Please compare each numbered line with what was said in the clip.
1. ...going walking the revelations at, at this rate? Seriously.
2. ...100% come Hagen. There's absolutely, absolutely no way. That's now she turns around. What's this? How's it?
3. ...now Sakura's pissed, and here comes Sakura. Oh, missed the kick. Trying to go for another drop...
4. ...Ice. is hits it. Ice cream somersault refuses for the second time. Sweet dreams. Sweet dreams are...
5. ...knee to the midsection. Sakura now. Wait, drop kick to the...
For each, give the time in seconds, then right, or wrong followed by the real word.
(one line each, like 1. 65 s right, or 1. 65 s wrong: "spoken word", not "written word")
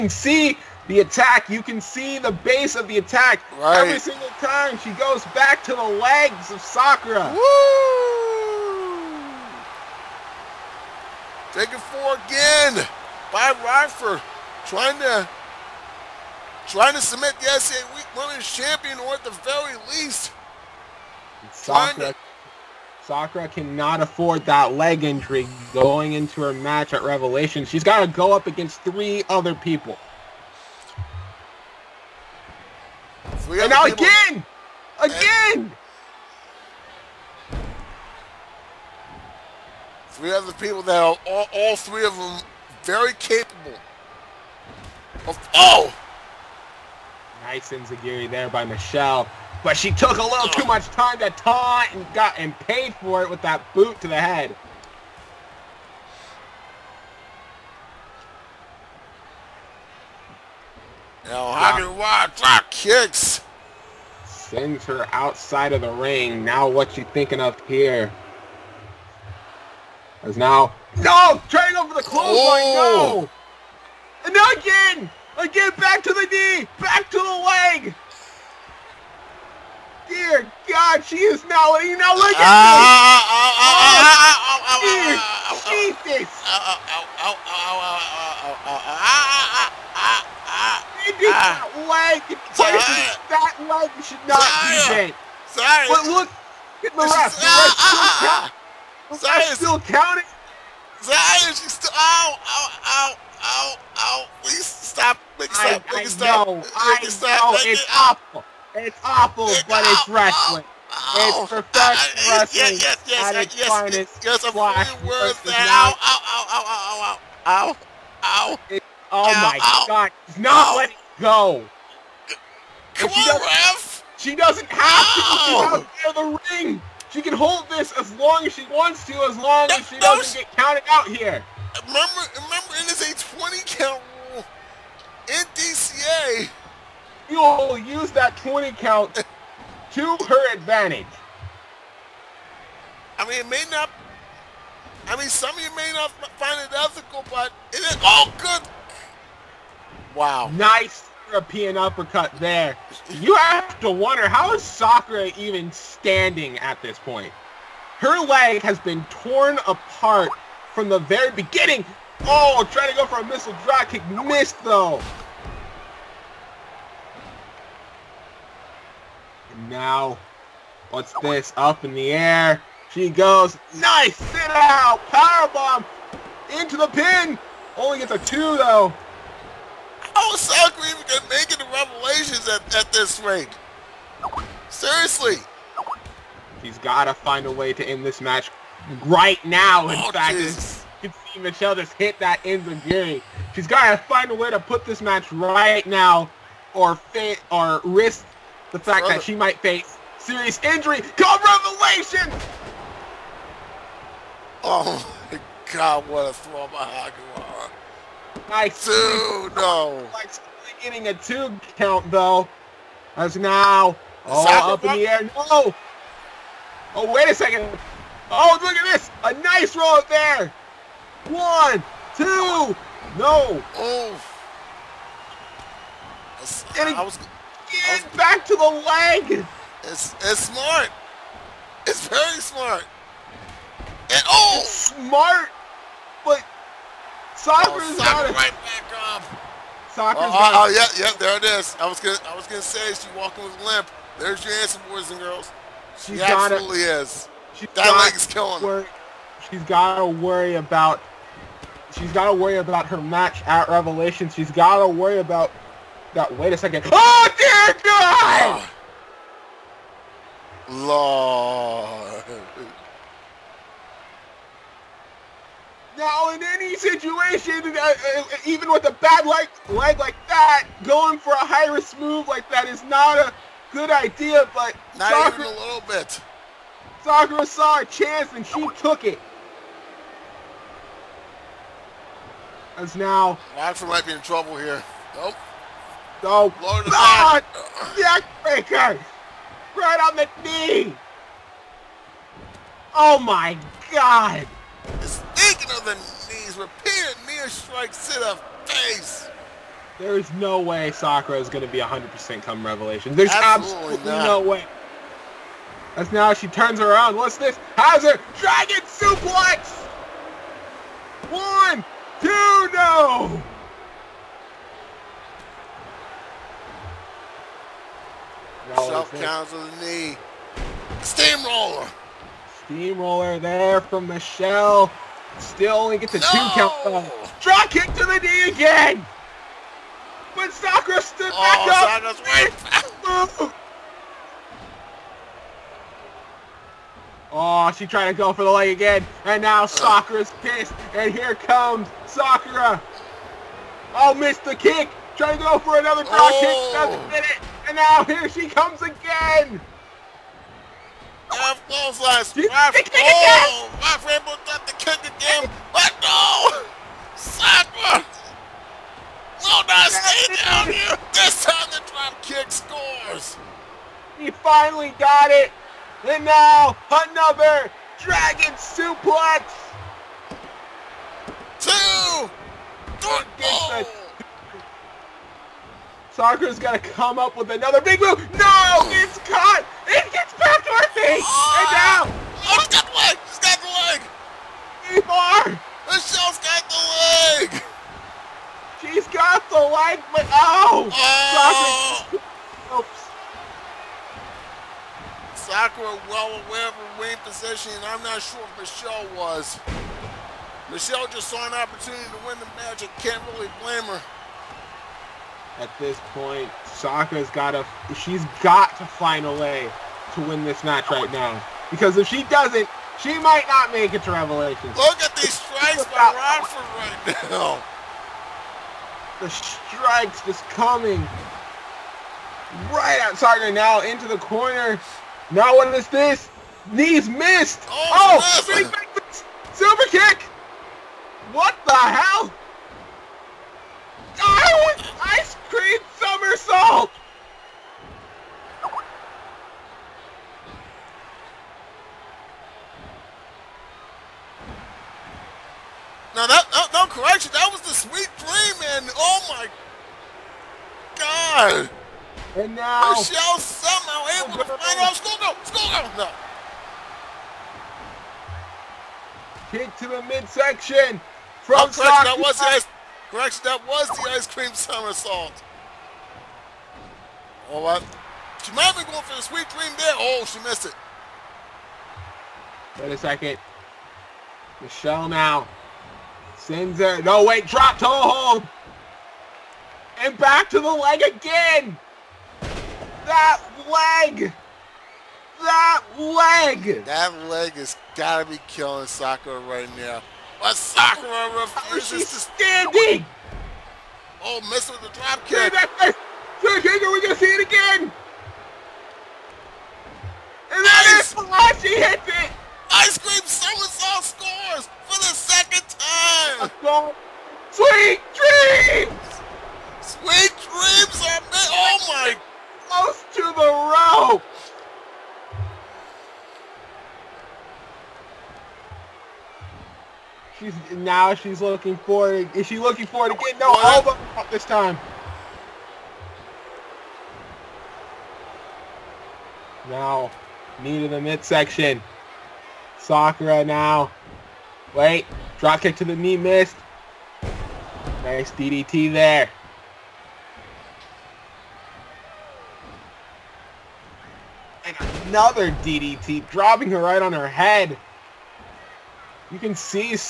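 1. 181 s wrong: "making", not "walking"
2. 301 s wrong: "Revelation", not "Hagen"
3. 339 s right
4. 500 s wrong: "scores", not "refuses"
5. 530 s right.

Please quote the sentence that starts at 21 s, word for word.
Sakura Sakura cannot afford that leg injury going into her match at Revelation.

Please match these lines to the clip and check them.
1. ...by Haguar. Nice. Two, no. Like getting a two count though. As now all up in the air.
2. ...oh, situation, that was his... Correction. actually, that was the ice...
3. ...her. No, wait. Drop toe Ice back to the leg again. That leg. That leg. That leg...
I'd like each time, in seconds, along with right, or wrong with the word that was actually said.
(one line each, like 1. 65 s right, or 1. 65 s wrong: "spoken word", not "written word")
1. 206 s right
2. 461 s wrong: "correction", not "situation"
3. 476 s wrong: "And", not "Ice".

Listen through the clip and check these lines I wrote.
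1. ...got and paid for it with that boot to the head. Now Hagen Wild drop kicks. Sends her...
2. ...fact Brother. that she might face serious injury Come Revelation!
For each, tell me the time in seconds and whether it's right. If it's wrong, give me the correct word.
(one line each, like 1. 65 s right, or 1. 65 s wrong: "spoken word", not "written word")
1. 52 s right
2. 198 s right.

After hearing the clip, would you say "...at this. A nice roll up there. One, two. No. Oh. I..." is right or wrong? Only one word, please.
right.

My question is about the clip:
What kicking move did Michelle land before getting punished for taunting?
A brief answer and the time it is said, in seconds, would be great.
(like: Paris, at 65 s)
Enzuigiri, at 47 s.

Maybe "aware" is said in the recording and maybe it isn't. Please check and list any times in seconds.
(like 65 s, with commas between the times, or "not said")
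396 s.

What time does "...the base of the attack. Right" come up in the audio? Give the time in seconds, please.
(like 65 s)
2 s.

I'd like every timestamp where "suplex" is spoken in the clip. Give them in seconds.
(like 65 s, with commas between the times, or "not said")
308 s, 368 s.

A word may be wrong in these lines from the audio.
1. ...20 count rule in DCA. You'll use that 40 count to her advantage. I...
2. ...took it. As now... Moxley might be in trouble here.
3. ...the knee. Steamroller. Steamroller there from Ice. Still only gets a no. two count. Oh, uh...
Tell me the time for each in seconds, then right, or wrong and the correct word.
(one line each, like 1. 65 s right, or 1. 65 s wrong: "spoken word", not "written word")
1. 133 s wrong: "20", not "40"
2. 278 s right
3. 319 s wrong: "Michelle", not "Ice".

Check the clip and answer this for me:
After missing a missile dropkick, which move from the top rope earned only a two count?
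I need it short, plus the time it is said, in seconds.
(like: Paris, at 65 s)
Sit out powerbomb, at 174 s.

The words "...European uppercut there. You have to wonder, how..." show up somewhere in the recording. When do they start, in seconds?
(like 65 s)
151 s.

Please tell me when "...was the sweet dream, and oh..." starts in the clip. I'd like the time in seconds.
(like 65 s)
447 s.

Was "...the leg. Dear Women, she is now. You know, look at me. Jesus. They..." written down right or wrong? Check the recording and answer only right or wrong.
wrong.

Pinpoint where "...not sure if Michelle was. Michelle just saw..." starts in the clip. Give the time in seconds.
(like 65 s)
398 s.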